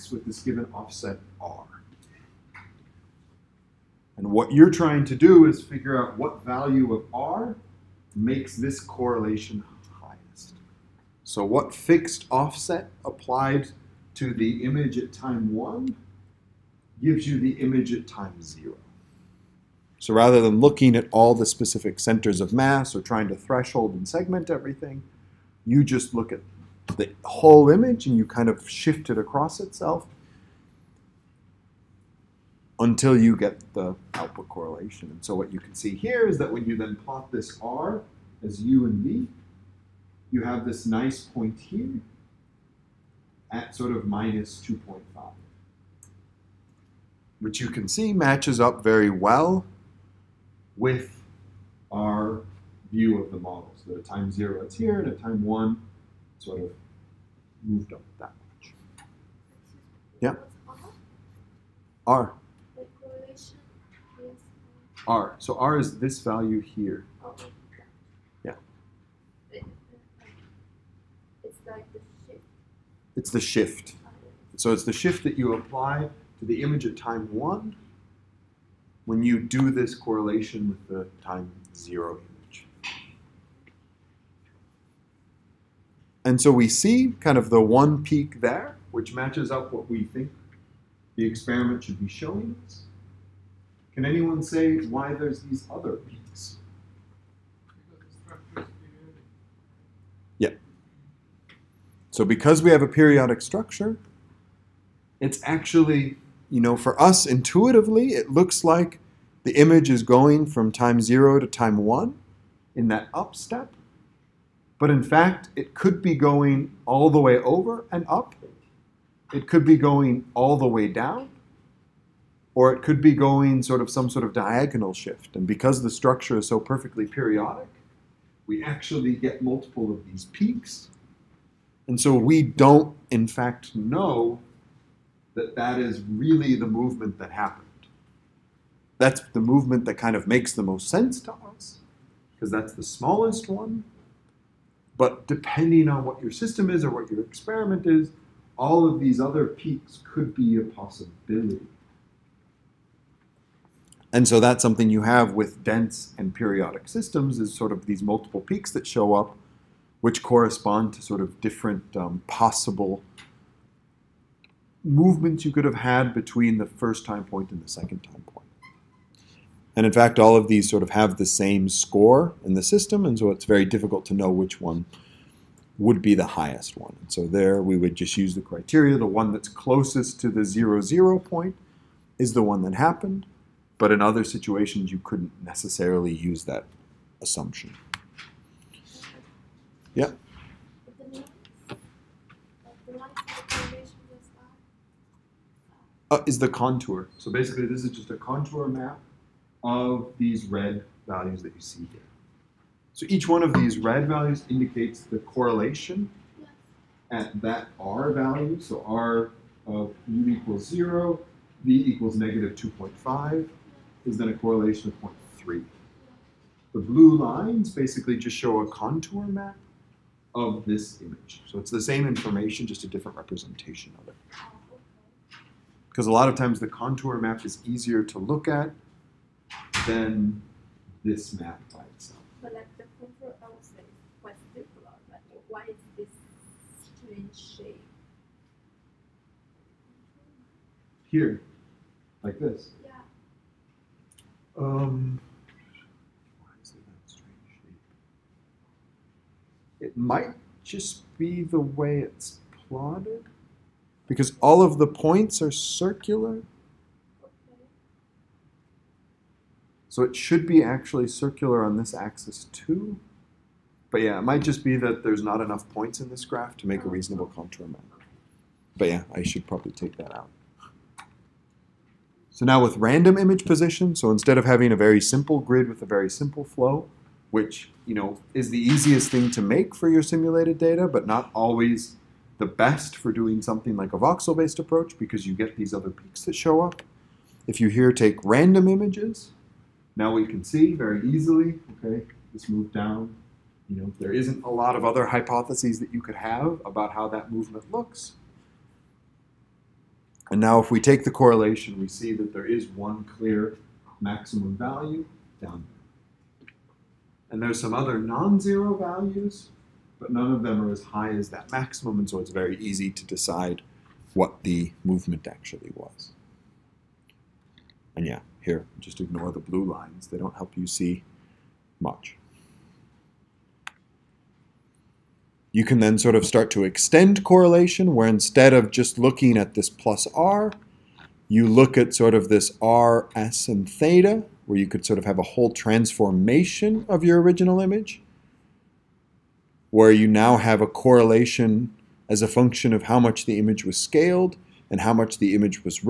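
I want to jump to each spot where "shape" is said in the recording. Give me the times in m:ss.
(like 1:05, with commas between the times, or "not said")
3:57, 4:07.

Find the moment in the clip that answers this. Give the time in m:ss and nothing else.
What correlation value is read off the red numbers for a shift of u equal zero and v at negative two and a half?
3:35.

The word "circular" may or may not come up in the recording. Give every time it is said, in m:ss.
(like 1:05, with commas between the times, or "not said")
3:54, 4:15, 4:21.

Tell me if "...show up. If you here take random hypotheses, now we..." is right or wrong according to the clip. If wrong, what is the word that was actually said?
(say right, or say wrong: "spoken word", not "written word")
wrong: "images", not "hypotheses".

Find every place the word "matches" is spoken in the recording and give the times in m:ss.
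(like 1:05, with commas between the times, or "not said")
0:48, 1:29.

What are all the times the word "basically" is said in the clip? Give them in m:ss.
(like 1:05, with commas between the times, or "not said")
3:17, 3:37.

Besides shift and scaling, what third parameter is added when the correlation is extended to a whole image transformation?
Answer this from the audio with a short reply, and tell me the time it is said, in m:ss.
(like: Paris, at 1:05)
theta, at 5:33.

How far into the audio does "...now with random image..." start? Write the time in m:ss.
4:32.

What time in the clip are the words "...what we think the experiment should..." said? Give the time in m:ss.
1:29.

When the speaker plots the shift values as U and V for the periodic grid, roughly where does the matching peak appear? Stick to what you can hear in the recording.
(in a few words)
-2.5.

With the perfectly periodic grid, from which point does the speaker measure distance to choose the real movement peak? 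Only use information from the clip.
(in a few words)
the zero, zero point.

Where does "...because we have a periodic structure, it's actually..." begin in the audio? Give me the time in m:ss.
1:42.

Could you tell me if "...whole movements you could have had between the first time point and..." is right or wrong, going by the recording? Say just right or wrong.
wrong.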